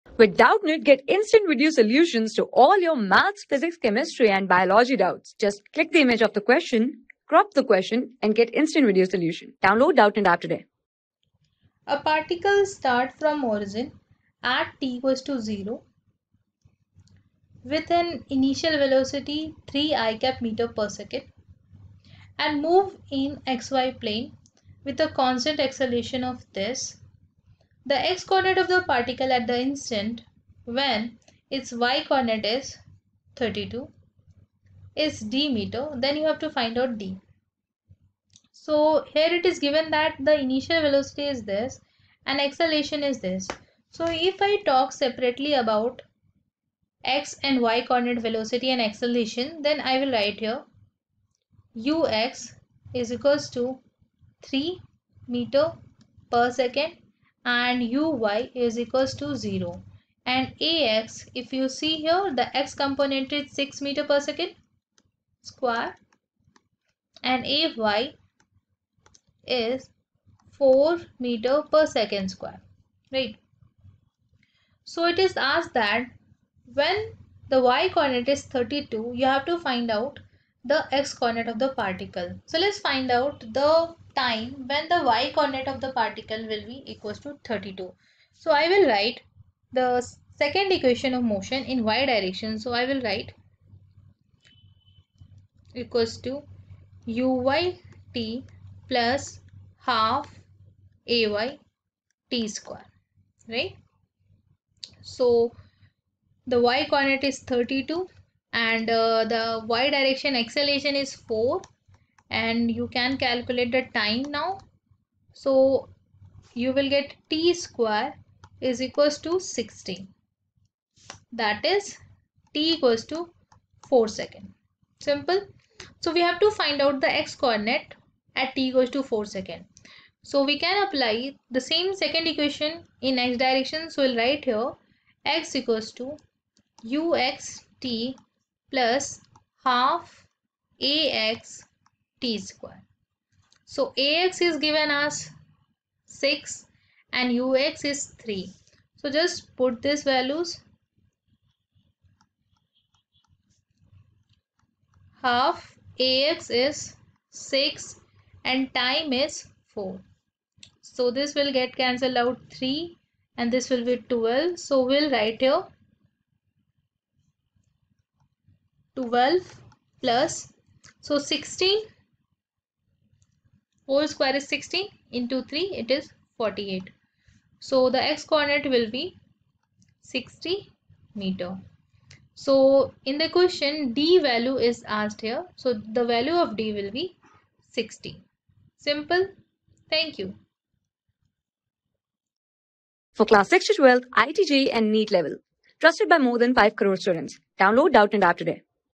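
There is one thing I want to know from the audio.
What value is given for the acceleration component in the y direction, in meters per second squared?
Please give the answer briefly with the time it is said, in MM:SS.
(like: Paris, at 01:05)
4, at 01:07.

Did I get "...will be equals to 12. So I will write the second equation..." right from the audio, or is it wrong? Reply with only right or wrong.
wrong.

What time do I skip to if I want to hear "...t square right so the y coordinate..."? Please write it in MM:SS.
01:42.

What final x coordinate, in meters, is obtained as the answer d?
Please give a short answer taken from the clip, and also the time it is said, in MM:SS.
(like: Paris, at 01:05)
60 meters, at 03:00.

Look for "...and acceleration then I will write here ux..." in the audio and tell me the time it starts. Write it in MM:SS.
00:48.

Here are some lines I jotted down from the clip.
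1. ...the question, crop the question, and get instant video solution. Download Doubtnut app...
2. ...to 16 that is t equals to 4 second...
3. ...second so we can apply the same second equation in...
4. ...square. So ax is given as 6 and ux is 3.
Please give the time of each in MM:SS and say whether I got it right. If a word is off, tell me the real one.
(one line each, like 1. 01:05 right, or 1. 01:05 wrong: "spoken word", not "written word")
1. 00:06 right
2. 01:59 right
3. 02:09 right
4. 02:22 right.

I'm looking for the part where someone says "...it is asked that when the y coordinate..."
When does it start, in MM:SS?
01:15.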